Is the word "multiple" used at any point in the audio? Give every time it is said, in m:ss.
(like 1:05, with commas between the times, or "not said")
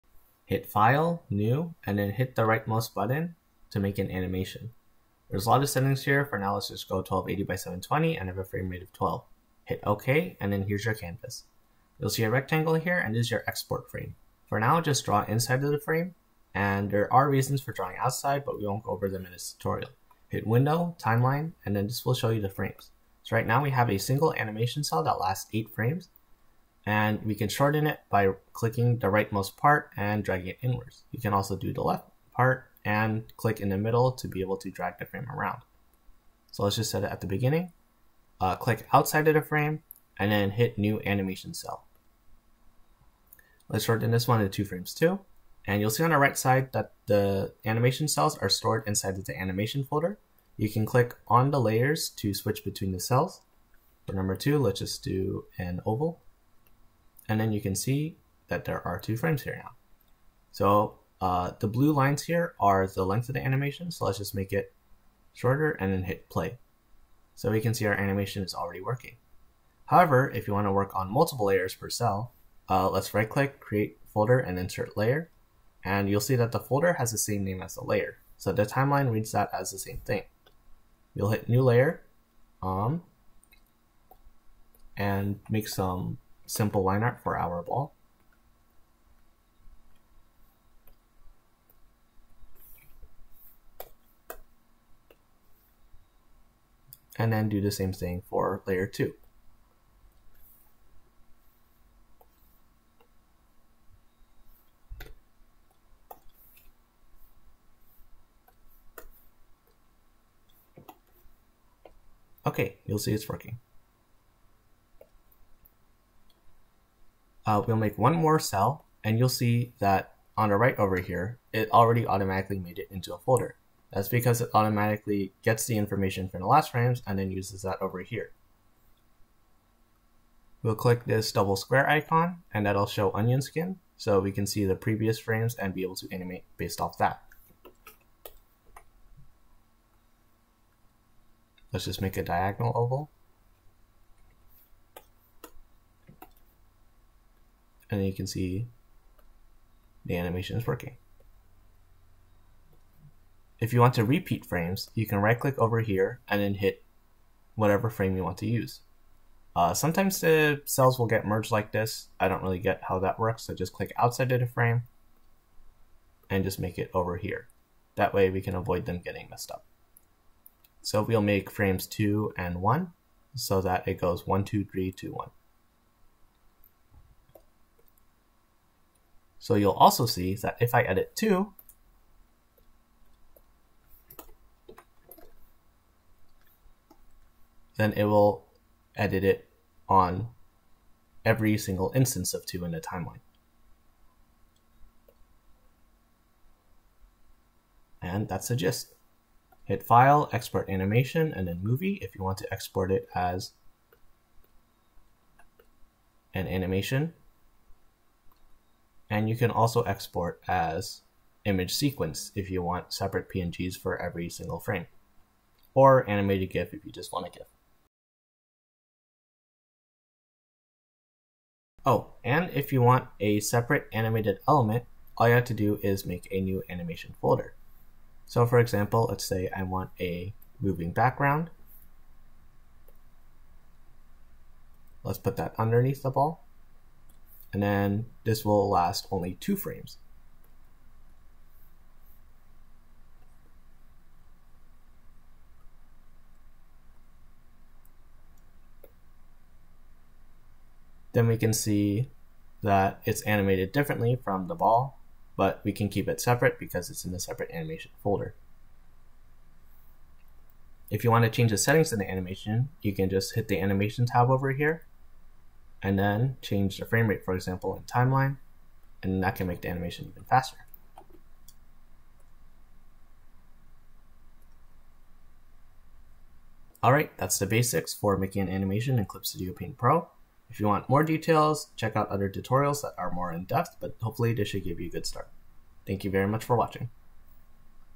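1:11.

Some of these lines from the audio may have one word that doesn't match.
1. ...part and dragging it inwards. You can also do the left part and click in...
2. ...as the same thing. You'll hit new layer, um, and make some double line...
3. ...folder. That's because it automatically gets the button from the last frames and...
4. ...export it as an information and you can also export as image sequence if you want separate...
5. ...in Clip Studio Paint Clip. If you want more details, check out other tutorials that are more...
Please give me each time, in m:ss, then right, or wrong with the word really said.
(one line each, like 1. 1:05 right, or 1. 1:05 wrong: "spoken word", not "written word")
1. 0:29 right
2. 1:19 wrong: "simple", not "double"
3. 2:03 wrong: "information", not "button"
4. 3:22 wrong: "animation", not "information"
5. 4:38 wrong: "Pro", not "Clip".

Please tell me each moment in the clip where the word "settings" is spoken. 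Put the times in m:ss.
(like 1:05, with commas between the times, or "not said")
0:05, 4:21.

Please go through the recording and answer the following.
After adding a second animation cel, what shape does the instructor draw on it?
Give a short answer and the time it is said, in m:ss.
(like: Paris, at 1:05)
An oval, at 0:55.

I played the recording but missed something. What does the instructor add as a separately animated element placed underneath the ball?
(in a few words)
A moving background.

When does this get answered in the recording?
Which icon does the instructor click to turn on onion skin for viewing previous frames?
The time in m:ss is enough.
2:11.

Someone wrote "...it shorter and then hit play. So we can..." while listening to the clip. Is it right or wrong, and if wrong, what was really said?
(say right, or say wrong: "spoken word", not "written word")
right.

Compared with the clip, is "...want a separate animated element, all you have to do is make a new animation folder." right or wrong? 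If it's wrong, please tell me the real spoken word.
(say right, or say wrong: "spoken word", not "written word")
right.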